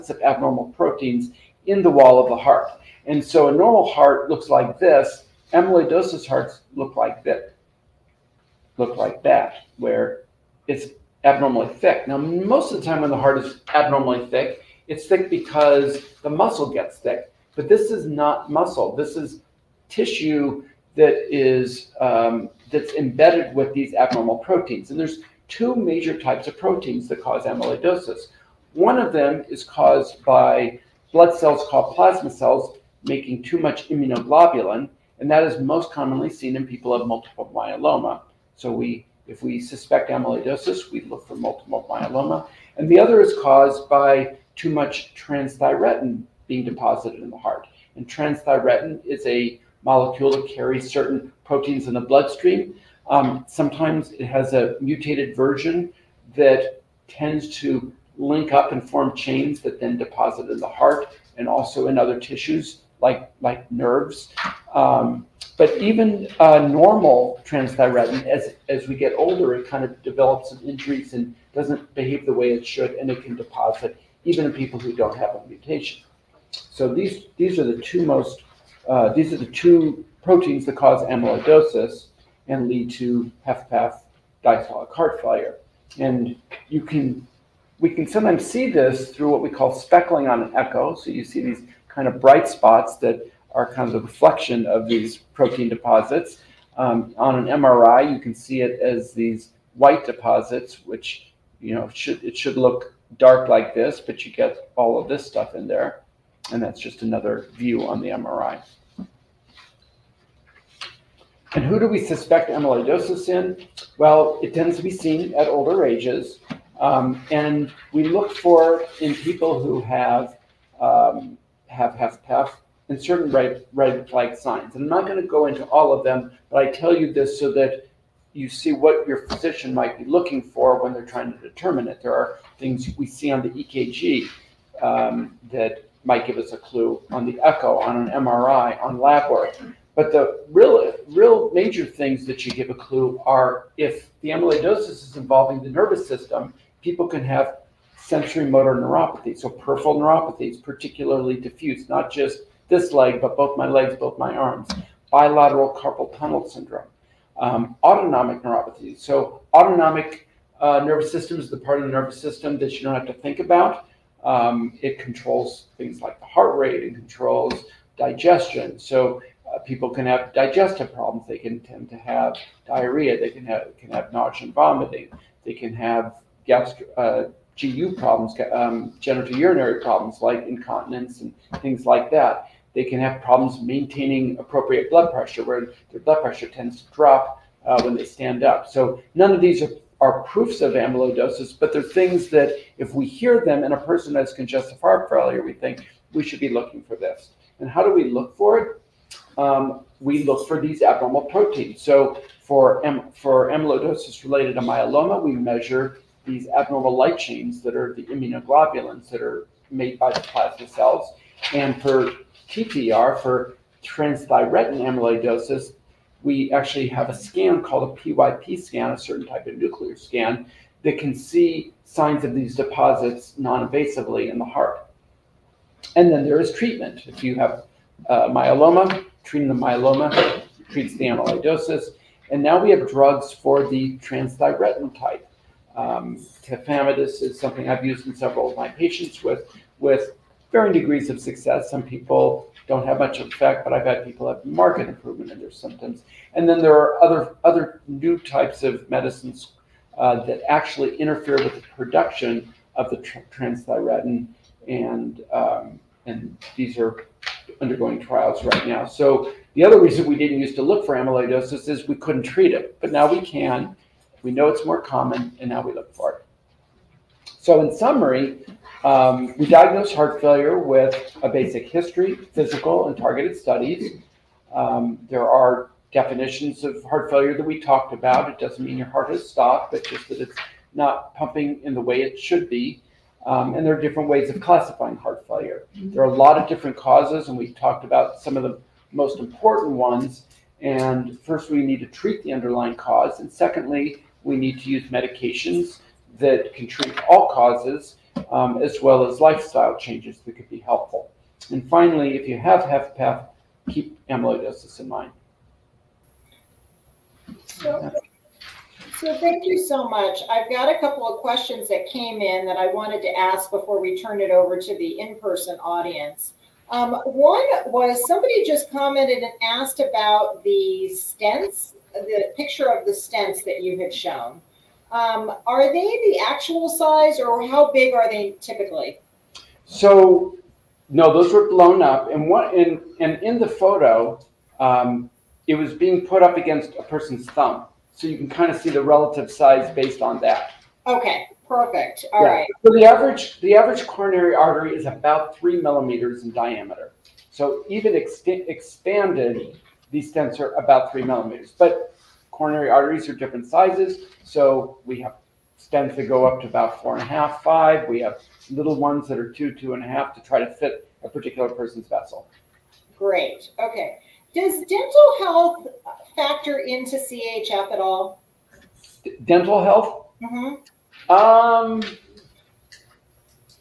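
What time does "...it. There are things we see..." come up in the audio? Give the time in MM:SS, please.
02:11.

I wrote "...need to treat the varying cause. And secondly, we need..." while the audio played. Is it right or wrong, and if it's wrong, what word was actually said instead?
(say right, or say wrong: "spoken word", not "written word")
wrong: "underlying", not "varying".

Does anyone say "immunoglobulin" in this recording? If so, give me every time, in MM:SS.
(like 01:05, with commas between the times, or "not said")
00:33, 03:28.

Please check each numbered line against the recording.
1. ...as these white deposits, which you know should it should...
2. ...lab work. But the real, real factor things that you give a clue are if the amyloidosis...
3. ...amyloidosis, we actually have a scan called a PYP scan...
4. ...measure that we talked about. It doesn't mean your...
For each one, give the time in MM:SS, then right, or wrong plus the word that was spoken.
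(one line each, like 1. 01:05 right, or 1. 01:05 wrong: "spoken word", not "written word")
1. 01:38 right
2. 02:18 wrong: "major", not "factor"
3. 03:34 right
4. 04:37 wrong: "failure", not "measure".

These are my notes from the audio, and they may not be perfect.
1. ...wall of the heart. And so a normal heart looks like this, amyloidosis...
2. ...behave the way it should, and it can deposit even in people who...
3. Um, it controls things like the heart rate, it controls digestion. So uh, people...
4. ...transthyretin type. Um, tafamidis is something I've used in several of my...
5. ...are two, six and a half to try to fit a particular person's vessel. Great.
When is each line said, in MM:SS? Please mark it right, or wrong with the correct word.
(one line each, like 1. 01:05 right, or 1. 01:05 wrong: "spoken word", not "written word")
1. 00:01 right
2. 01:11 right
3. 02:44 right
4. 03:53 right
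5. 05:59 wrong: "two", not "six".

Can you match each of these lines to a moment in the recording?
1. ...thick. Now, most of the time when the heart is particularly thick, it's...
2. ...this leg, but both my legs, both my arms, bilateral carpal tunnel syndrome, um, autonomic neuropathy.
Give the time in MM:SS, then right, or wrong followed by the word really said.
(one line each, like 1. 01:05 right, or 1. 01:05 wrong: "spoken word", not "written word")
1. 00:11 wrong: "abnormally", not "particularly"
2. 02:32 right.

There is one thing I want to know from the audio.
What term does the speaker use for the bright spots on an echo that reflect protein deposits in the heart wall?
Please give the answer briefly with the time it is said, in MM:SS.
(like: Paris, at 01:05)
speckling, at 01:29.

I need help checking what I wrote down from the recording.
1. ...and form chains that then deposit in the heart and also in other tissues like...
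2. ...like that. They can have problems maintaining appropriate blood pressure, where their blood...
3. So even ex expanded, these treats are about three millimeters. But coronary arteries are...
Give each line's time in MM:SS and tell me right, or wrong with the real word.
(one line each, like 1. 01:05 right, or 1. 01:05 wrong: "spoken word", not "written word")
1. 00:58 right
2. 03:01 right
3. 05:47 wrong: "stents", not "treats".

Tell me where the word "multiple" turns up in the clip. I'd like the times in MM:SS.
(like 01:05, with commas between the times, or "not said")
00:37, 00:41.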